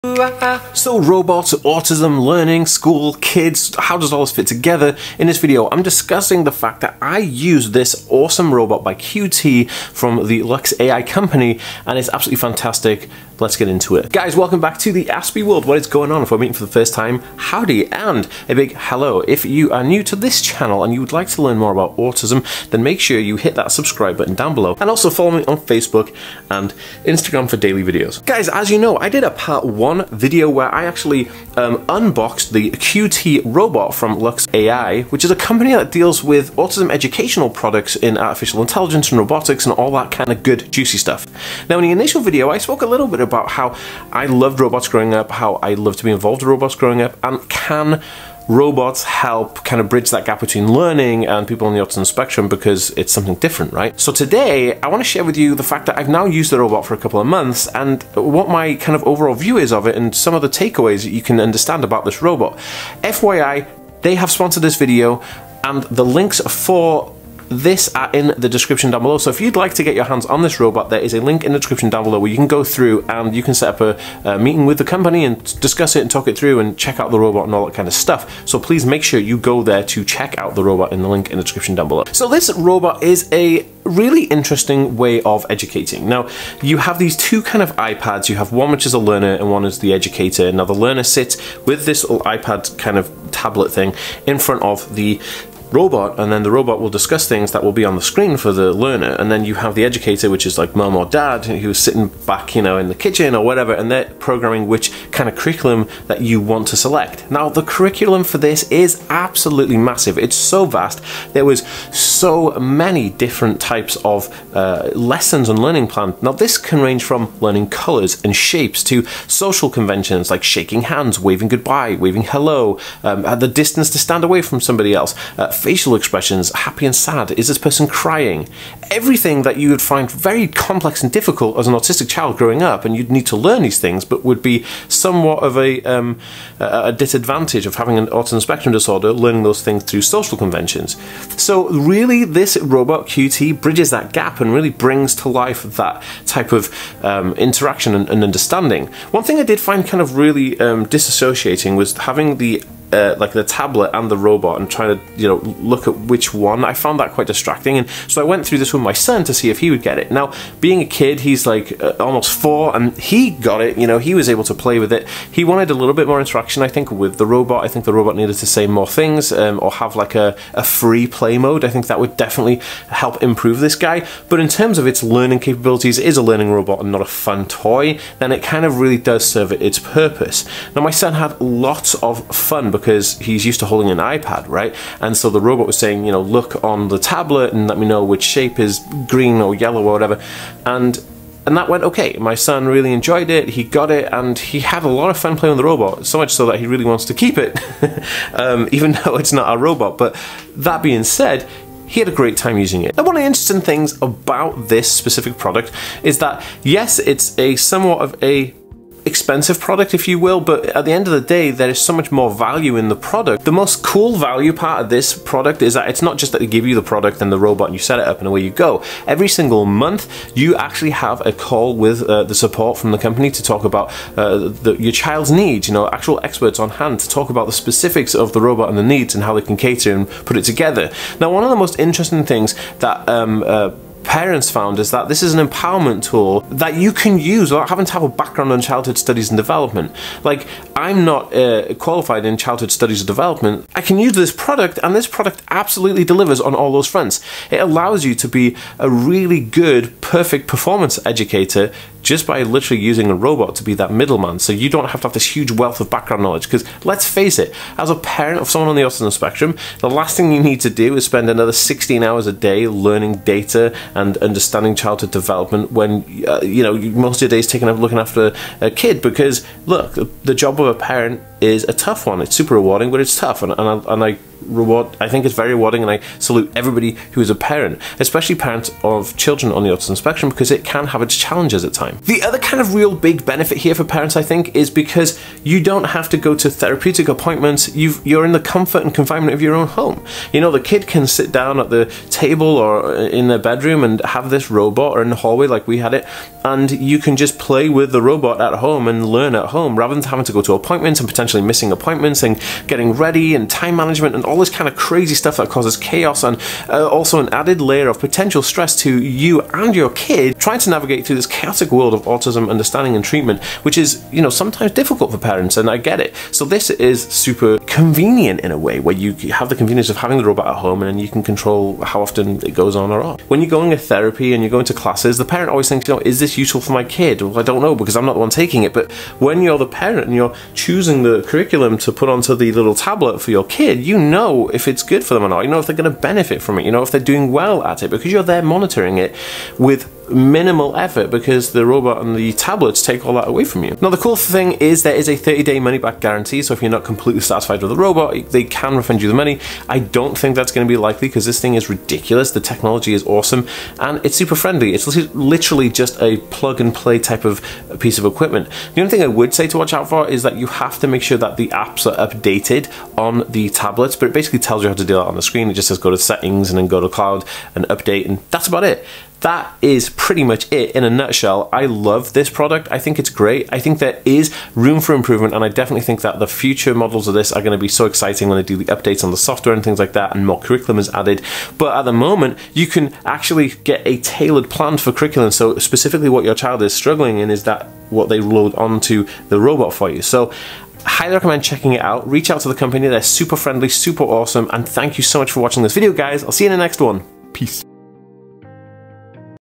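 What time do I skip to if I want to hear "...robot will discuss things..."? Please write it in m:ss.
1:36.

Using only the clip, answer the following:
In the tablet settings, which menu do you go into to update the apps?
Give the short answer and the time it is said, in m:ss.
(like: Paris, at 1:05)
cloud, at 6:06.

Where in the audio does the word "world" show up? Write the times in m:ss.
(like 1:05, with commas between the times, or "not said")
0:15, 5:11.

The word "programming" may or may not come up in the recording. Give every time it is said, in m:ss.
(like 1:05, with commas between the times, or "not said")
1:44.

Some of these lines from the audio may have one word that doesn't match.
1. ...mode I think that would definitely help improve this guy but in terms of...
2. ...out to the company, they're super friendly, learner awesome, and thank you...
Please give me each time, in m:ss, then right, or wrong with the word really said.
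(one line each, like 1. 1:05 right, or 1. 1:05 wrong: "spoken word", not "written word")
1. 2:51 right
2. 6:32 wrong: "super", not "learner".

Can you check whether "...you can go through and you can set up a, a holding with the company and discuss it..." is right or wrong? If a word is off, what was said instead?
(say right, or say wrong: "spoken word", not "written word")
wrong: "meeting", not "holding".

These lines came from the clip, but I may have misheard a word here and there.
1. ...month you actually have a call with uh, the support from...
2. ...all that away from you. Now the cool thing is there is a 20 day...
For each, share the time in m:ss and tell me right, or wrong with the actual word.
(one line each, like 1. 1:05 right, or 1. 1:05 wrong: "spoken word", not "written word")
1. 3:39 right
2. 5:43 wrong: "30", not "20".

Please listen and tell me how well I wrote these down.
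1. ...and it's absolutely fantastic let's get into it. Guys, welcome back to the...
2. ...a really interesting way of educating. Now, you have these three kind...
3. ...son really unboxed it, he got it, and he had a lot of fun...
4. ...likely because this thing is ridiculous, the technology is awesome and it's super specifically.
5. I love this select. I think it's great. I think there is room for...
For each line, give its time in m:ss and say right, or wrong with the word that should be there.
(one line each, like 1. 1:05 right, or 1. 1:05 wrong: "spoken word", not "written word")
1. 0:11 right
2. 1:23 wrong: "two", not "three"
3. 3:12 wrong: "enjoyed", not "unboxed"
4. 5:50 wrong: "friendly", not "specifically"
5. 6:11 wrong: "product", not "select".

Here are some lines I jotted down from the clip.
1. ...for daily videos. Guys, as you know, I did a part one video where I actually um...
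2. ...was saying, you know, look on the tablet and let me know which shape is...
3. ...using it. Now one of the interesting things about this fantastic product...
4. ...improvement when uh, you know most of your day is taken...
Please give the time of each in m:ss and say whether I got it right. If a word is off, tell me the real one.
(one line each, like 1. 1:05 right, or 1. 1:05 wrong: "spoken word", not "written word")
1. 0:27 right
2. 3:05 right
3. 3:22 wrong: "specific", not "fantastic"
4. 4:25 wrong: "development", not "improvement".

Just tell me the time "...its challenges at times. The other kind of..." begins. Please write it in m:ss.
4:41.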